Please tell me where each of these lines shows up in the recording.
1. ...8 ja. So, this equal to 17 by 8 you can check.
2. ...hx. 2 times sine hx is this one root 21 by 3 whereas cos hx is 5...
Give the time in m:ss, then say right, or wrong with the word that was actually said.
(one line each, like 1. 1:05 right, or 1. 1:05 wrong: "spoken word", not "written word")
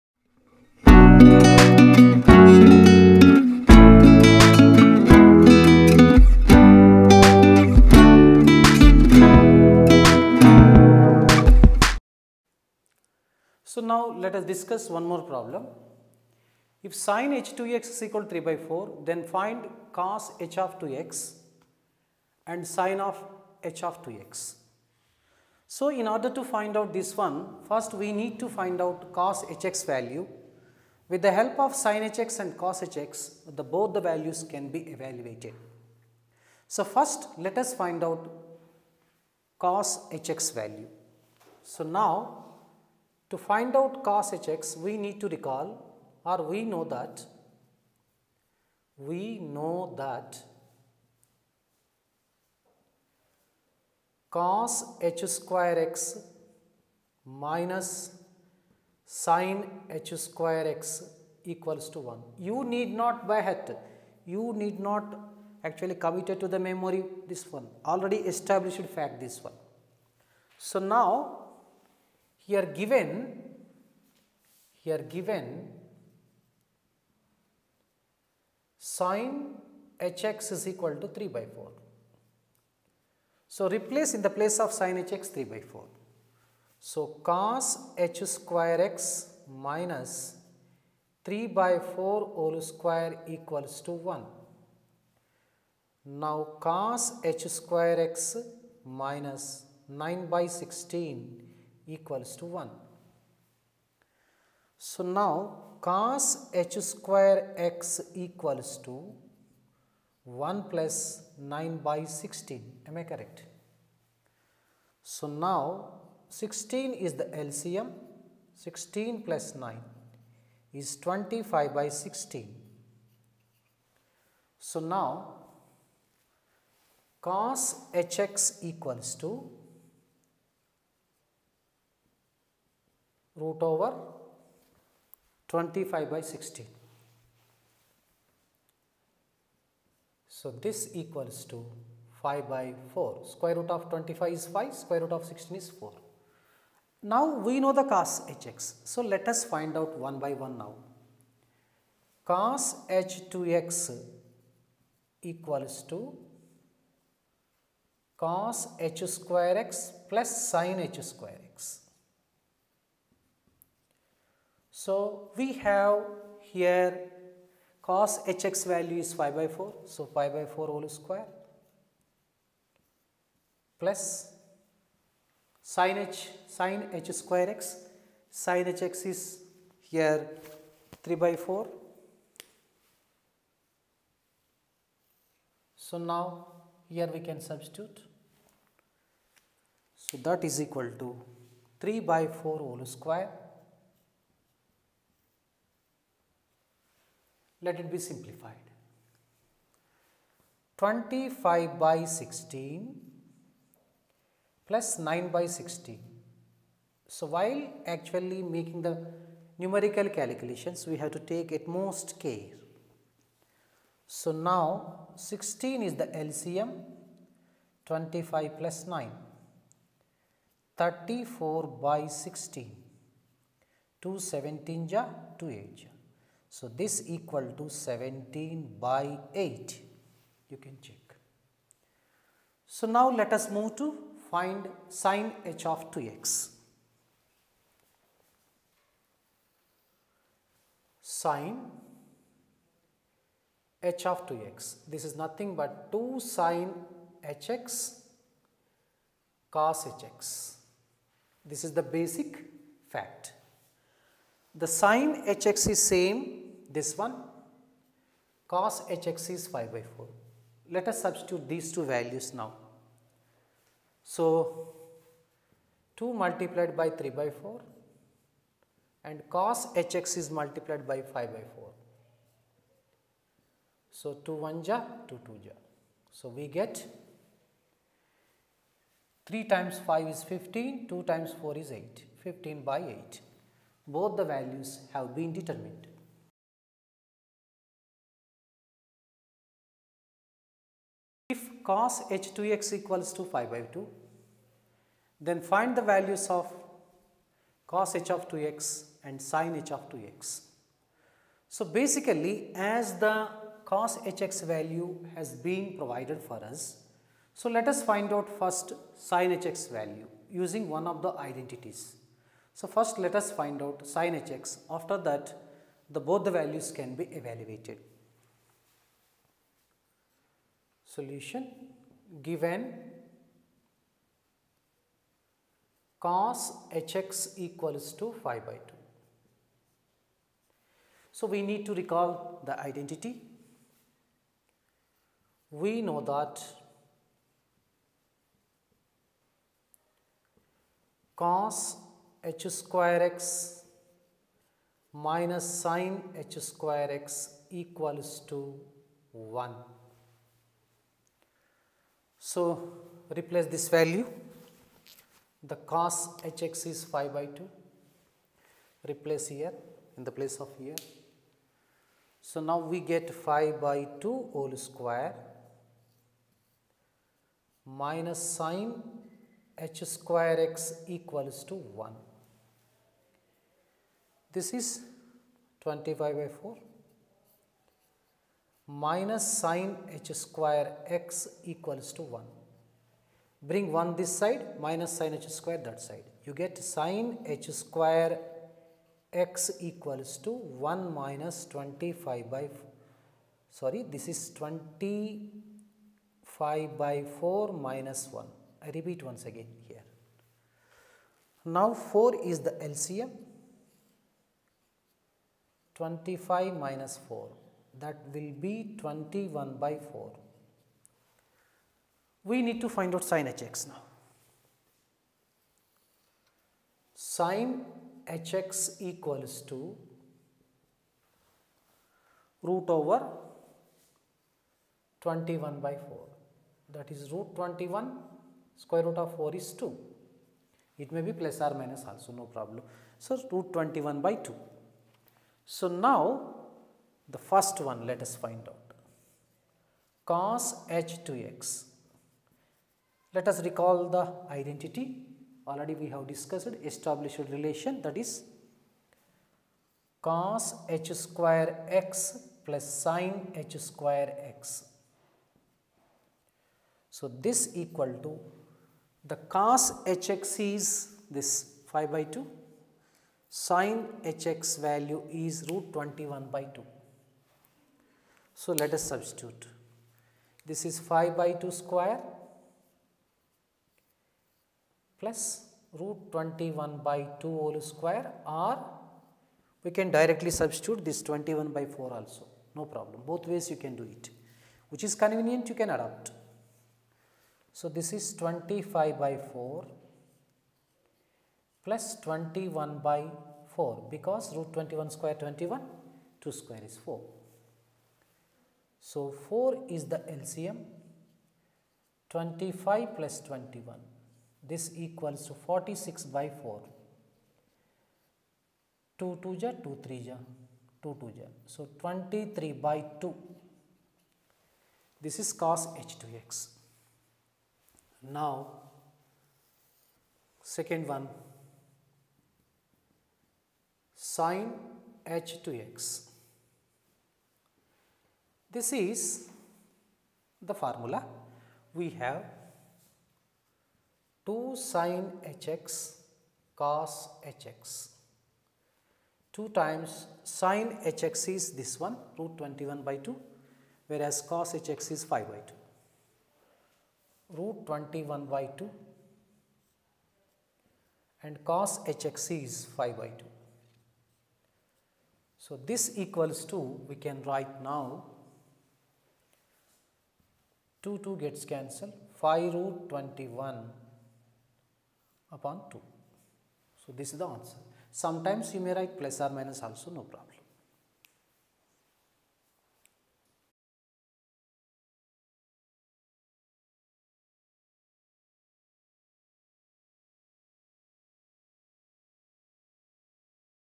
1. 3:45 right
2. 8:57 wrong: "2", not "3".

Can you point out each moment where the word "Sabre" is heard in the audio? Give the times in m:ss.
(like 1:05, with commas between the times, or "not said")
not said.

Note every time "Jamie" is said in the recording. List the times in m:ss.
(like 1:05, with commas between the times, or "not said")
not said.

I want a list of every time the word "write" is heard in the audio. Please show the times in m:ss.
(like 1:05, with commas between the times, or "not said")
9:17, 9:28.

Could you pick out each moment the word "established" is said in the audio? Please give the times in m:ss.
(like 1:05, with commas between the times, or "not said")
1:08, 7:26.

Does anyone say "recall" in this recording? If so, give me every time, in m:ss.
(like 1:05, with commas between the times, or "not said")
0:45, 5:31, 7:23.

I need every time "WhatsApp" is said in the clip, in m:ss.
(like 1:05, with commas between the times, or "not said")
not said.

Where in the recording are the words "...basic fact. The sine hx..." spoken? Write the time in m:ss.
4:11.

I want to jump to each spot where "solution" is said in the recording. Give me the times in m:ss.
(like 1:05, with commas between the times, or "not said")
5:20.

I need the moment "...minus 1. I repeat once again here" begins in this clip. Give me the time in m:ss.
6:37.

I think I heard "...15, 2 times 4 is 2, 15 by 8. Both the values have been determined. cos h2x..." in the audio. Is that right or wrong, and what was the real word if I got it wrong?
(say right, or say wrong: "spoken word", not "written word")
wrong: "8", not "2".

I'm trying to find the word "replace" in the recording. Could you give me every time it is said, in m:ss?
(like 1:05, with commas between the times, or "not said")
1:23, 5:53, 5:58.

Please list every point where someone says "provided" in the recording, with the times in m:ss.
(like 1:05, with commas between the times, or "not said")
5:05.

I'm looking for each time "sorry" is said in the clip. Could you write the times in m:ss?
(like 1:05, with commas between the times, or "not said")
6:33.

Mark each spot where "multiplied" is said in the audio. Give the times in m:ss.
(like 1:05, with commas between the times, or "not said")
4:26, 4:30.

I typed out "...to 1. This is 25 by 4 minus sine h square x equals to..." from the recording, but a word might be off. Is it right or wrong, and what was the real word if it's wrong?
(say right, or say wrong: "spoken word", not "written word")
right.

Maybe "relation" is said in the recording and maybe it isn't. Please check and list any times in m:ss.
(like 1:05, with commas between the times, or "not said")
7:27.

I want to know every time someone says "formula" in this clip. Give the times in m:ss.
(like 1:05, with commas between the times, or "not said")
8:50.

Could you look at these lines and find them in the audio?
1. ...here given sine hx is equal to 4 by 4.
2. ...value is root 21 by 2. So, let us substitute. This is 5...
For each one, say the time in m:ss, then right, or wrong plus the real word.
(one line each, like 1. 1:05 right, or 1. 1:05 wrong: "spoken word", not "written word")
1. 1:14 wrong: "3", not "4"
2. 7:44 right.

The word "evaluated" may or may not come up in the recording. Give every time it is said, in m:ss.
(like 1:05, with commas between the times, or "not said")
0:34, 5:17.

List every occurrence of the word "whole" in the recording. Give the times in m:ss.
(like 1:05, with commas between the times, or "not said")
1:32, 2:50, 3:12, 6:04, 7:57.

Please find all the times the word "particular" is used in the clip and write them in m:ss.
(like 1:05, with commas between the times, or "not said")
not said.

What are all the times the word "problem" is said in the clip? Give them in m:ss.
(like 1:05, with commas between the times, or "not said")
0:15, 7:12, 8:02, 9:30.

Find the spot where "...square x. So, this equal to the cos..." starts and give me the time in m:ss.
7:33.